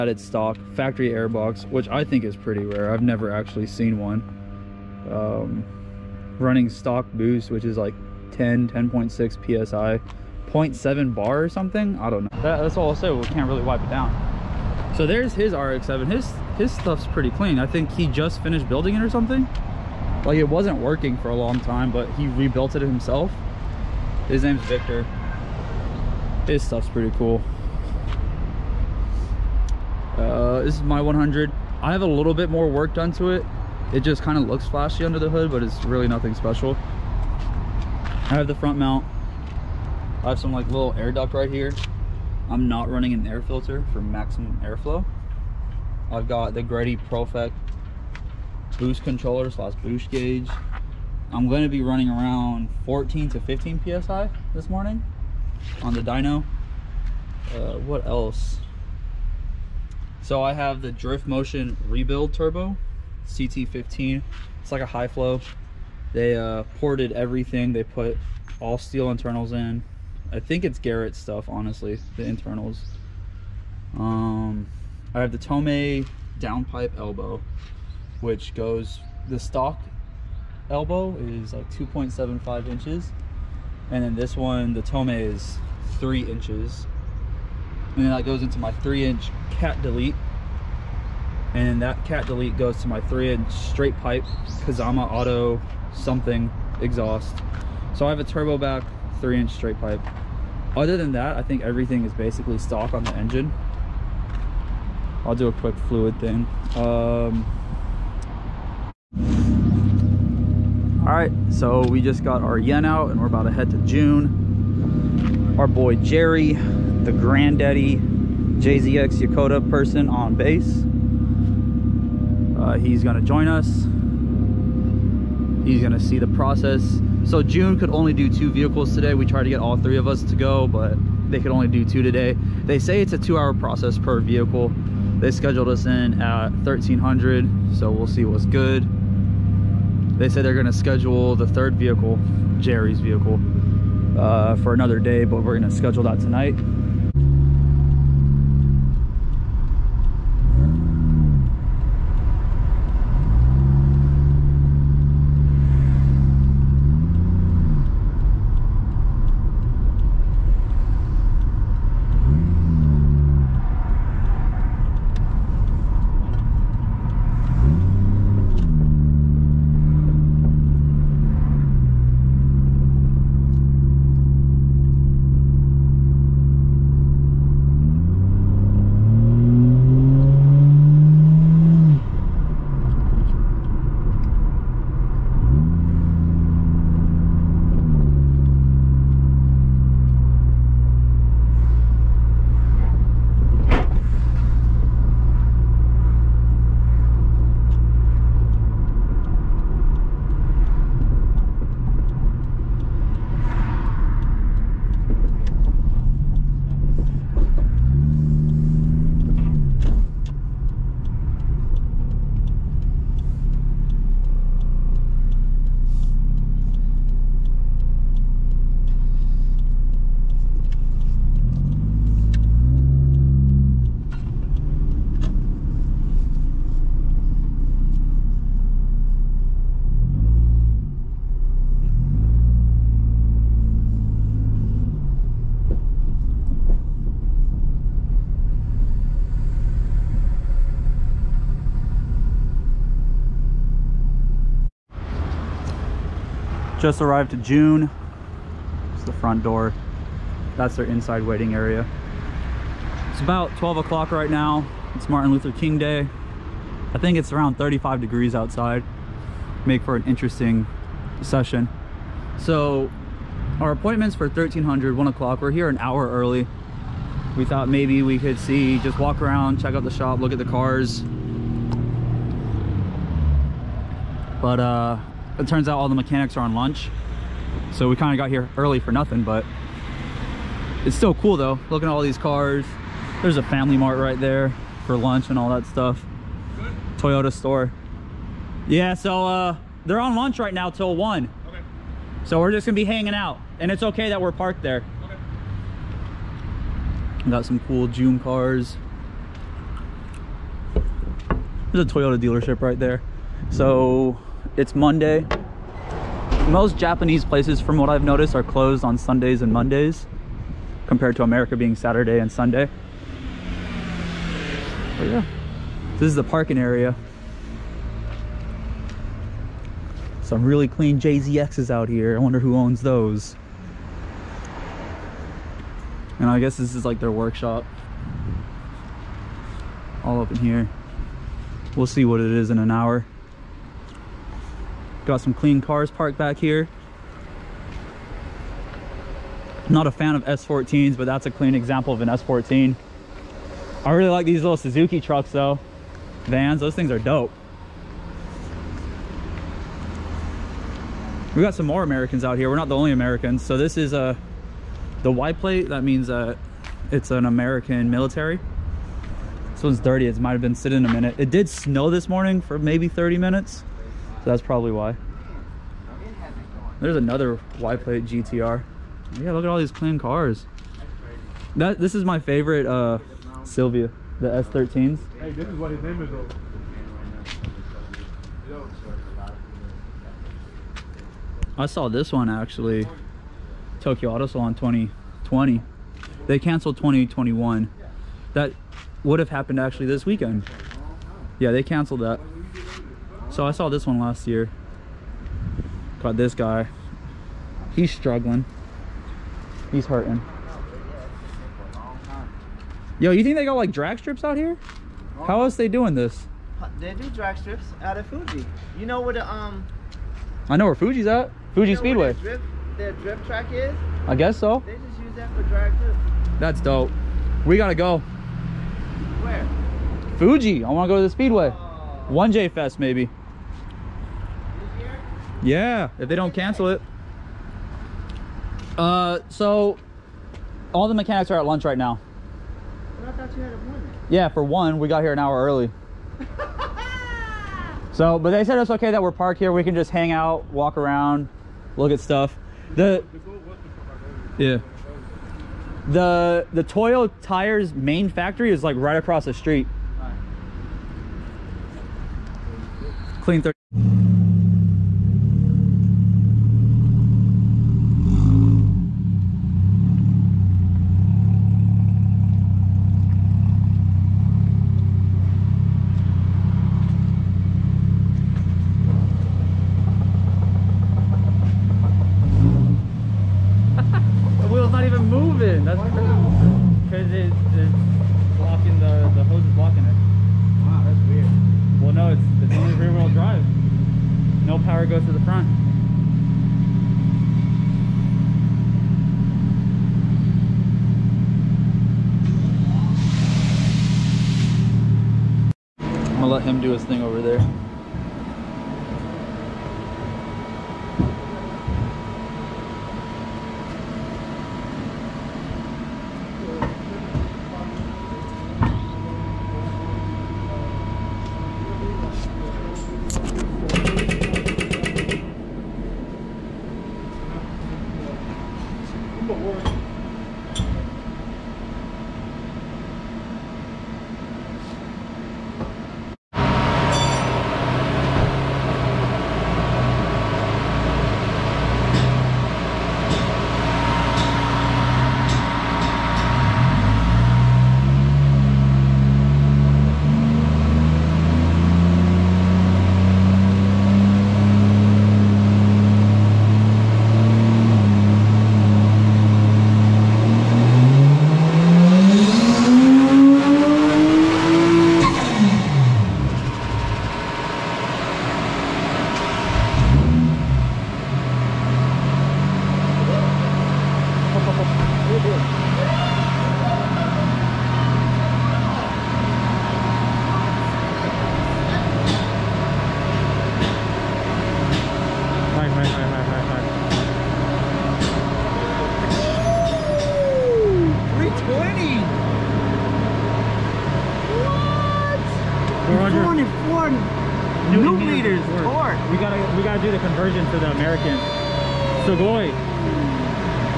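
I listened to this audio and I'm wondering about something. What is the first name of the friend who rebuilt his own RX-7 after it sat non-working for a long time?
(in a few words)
Victor.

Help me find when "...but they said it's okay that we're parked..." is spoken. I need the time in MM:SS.
07:18.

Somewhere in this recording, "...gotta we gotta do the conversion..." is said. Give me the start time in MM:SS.
09:49.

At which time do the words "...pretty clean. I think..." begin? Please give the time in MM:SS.
00:17.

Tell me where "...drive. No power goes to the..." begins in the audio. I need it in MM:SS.
08:03.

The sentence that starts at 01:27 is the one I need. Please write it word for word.
And then that goes into my three inch cat delete.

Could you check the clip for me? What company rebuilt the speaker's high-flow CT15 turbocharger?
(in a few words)
Drift Motion.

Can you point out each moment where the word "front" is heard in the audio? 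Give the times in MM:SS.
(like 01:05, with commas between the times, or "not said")
00:38, 04:09, 08:05.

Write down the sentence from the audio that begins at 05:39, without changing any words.
Not a fan of S14s, but that's a clean example of an S14.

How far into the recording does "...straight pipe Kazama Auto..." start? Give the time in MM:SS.
01:33.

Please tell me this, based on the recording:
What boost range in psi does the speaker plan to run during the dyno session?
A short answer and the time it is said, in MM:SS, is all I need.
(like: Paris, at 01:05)
14 to 15 psi, at 00:52.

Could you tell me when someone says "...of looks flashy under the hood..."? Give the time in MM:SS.
00:34.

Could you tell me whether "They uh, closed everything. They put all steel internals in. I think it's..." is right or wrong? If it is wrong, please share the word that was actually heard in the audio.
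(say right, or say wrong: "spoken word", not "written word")
wrong: "ported", not "closed".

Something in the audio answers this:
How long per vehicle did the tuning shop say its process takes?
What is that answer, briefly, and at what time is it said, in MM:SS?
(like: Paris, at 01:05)
2 hours, at 02:13.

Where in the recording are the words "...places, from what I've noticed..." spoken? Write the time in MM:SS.
05:07.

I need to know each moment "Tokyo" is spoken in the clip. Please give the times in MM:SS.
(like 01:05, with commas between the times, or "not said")
06:23.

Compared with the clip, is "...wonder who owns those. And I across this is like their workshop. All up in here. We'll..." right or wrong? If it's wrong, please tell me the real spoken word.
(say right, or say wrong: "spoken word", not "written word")
wrong: "guess", not "across".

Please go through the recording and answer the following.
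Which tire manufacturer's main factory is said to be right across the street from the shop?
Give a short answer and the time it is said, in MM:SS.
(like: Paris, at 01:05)
Toyo, at 07:26.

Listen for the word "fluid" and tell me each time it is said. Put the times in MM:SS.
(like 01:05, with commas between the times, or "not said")
01:45.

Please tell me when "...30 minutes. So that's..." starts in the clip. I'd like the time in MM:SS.
06:02.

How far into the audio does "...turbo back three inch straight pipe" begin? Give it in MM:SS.
01:38.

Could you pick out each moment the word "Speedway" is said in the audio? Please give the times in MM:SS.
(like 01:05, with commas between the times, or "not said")
06:51, 07:01.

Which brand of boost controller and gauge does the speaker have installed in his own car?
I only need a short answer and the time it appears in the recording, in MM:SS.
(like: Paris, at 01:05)
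Greddy Profec, at 00:46.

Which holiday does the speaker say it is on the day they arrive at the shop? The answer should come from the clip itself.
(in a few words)
Martin Luther King Day.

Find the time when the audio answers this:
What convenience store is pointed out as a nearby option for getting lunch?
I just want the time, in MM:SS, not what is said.
04:43.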